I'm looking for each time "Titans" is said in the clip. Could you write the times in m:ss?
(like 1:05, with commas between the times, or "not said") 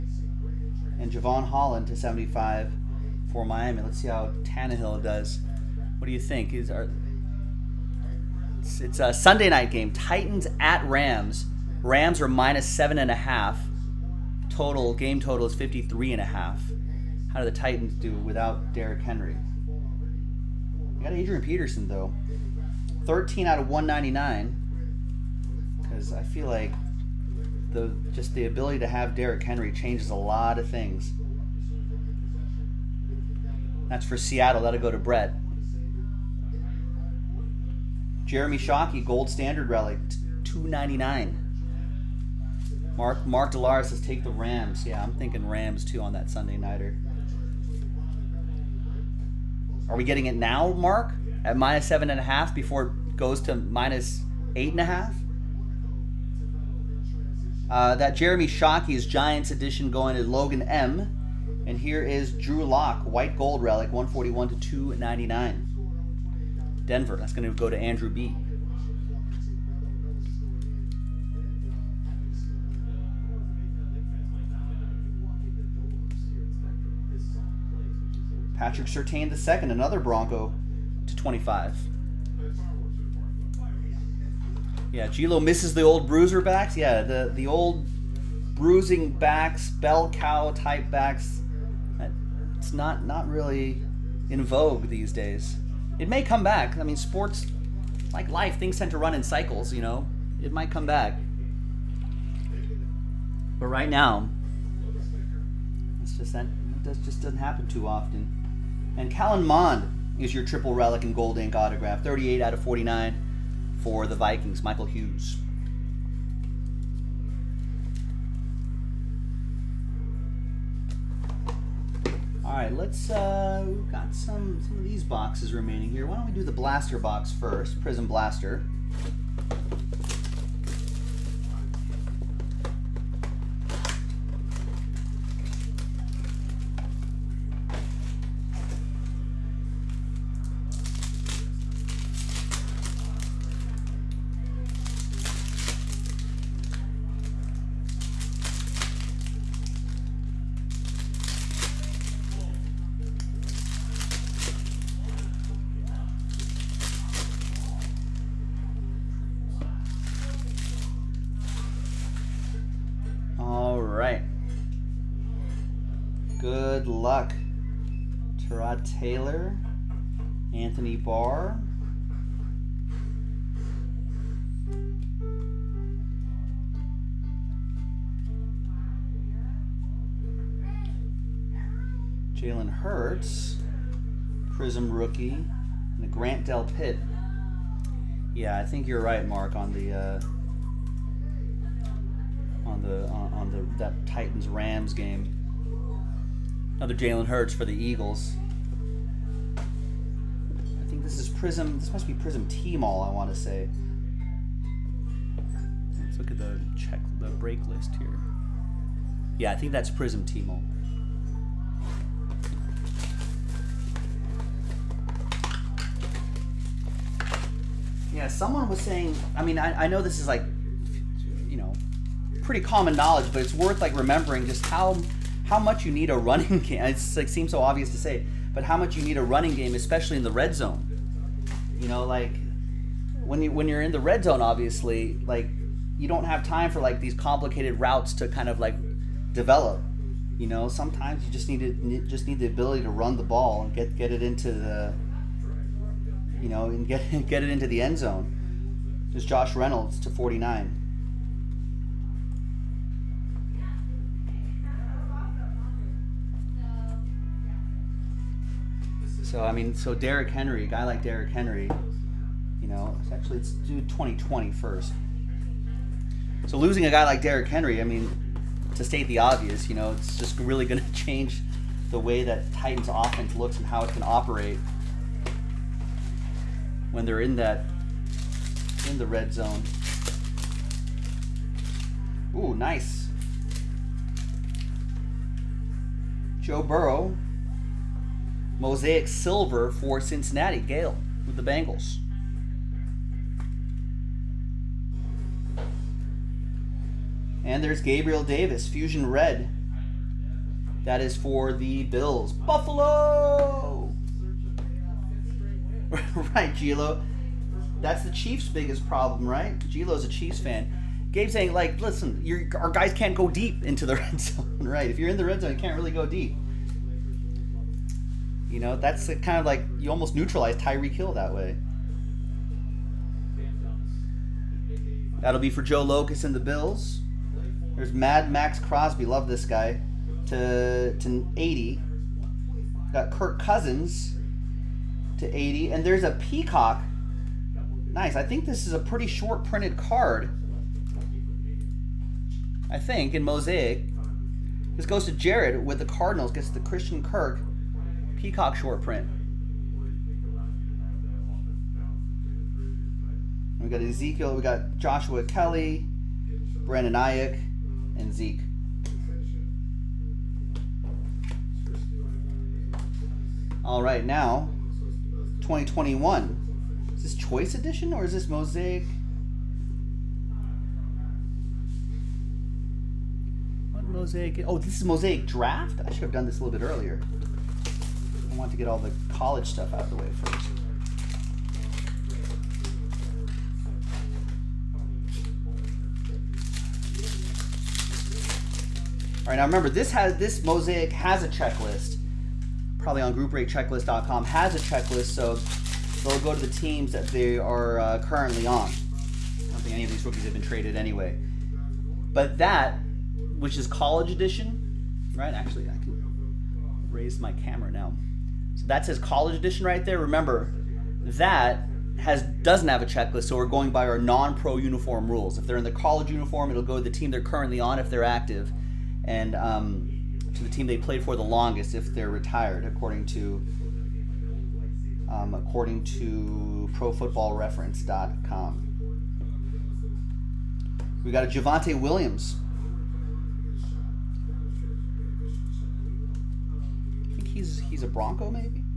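0:09, 0:17, 3:14, 4:32.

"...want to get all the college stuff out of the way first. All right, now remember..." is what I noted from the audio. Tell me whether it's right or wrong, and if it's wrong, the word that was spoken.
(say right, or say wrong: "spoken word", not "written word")
right.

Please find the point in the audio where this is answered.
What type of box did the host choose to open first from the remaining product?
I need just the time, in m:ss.
2:07.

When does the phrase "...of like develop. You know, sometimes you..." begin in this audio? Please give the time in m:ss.
3:58.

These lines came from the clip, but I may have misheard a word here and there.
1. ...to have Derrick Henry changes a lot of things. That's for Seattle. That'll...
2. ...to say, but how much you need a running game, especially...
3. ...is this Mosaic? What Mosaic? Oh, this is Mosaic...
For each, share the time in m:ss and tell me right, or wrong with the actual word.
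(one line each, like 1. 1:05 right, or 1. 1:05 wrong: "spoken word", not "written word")
1. 0:28 right
2. 3:47 right
3. 6:08 right.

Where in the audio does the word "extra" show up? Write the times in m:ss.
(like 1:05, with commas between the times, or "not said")
not said.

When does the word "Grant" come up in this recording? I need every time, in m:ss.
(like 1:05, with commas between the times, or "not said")
3:06.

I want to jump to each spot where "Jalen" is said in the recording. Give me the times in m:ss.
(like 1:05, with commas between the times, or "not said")
3:02, 3:17.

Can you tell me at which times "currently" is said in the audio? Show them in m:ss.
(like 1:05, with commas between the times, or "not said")
6:37, 6:57.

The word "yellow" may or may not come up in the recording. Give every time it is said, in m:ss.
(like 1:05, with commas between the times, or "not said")
not said.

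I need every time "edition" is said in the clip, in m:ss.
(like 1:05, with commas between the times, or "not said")
0:59, 6:07, 6:44, 6:49.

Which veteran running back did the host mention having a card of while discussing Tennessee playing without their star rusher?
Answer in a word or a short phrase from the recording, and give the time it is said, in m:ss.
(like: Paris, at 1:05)
Adrian Peterson, at 0:21.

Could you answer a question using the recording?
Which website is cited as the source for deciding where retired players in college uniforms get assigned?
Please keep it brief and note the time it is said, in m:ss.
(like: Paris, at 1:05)
ProFootballReference.com, at 7:06.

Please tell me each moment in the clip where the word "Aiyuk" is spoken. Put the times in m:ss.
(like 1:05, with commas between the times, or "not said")
5:56.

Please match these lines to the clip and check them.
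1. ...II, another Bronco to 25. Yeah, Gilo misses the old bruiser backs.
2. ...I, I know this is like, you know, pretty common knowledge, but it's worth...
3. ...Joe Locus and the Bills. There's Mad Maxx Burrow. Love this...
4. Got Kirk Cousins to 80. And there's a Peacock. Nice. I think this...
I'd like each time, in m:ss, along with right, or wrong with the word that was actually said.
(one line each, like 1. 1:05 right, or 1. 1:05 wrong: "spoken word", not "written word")
1. 1:19 right
2. 3:39 right
3. 5:25 wrong: "Crosby", not "Burrow"
4. 5:32 right.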